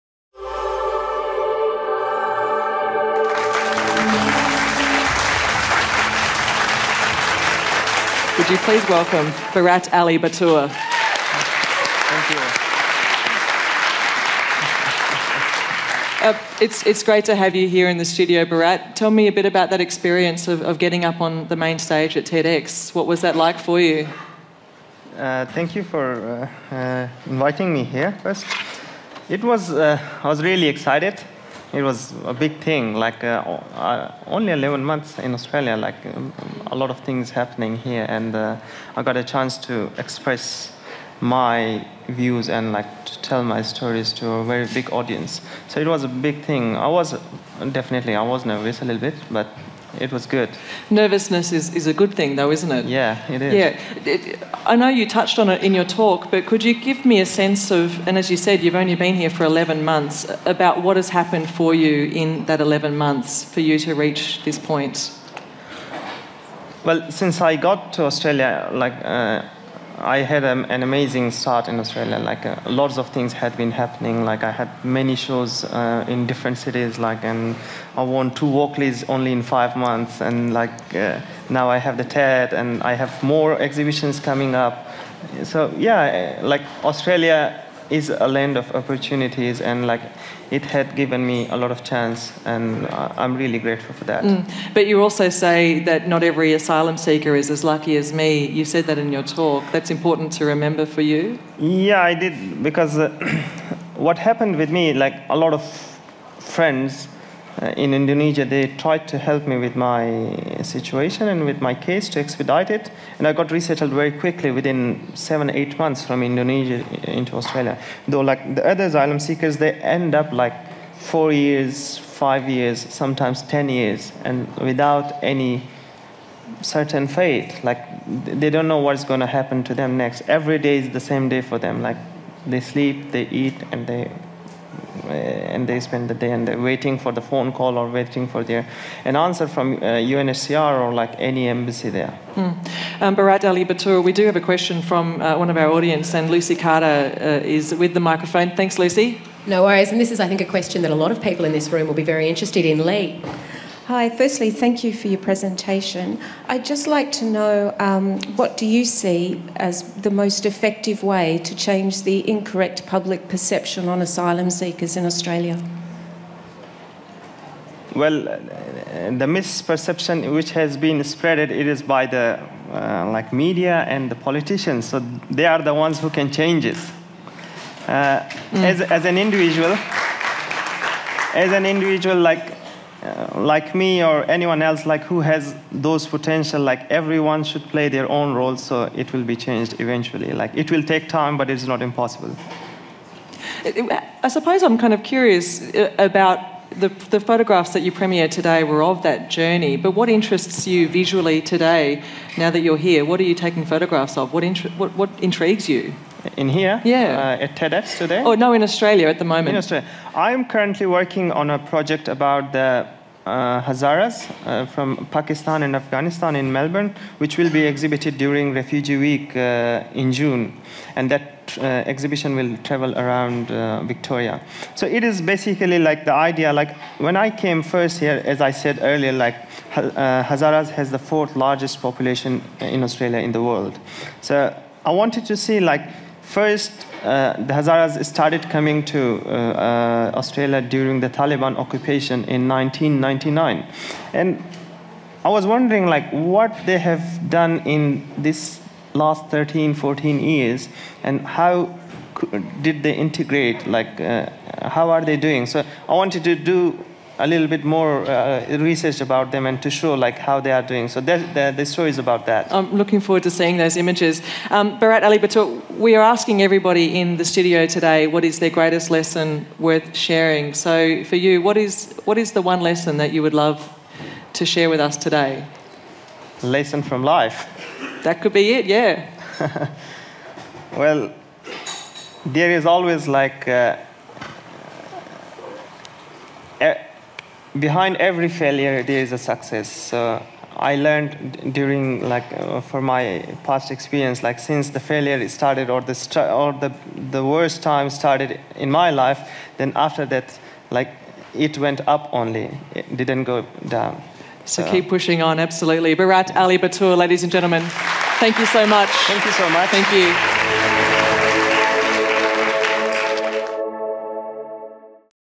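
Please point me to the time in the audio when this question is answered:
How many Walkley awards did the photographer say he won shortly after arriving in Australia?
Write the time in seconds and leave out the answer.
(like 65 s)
77 s.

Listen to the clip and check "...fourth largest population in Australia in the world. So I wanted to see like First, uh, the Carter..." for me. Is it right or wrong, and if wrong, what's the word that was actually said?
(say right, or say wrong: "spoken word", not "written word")
wrong: "Hazaras", not "Carter".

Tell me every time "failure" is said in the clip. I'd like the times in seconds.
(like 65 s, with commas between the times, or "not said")
288 s, 294 s.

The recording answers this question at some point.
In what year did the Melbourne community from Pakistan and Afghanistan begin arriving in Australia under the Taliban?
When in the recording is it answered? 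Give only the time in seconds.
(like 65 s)
242 s.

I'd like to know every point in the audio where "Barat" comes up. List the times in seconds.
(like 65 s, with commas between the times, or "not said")
9 s, 18 s, 143 s, 264 s, 305 s.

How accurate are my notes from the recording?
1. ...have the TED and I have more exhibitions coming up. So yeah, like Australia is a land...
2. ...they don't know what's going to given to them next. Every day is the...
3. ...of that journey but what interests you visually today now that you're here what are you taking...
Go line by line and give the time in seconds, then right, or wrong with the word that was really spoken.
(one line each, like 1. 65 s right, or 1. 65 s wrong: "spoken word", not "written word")
1. 81 s right
2. 128 s wrong: "happen", not "given"
3. 198 s right.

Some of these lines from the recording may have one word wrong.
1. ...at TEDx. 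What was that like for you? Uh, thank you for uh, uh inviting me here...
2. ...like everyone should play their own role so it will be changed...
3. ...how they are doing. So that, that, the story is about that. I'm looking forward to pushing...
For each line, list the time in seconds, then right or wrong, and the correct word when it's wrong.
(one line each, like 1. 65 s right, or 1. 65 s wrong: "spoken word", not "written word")
1. 22 s right
2. 186 s right
3. 260 s wrong: "seeing", not "pushing".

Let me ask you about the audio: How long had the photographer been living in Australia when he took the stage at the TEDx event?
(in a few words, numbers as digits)
11 months.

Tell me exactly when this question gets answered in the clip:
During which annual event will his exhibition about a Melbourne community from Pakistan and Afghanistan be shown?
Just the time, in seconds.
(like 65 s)
218 s.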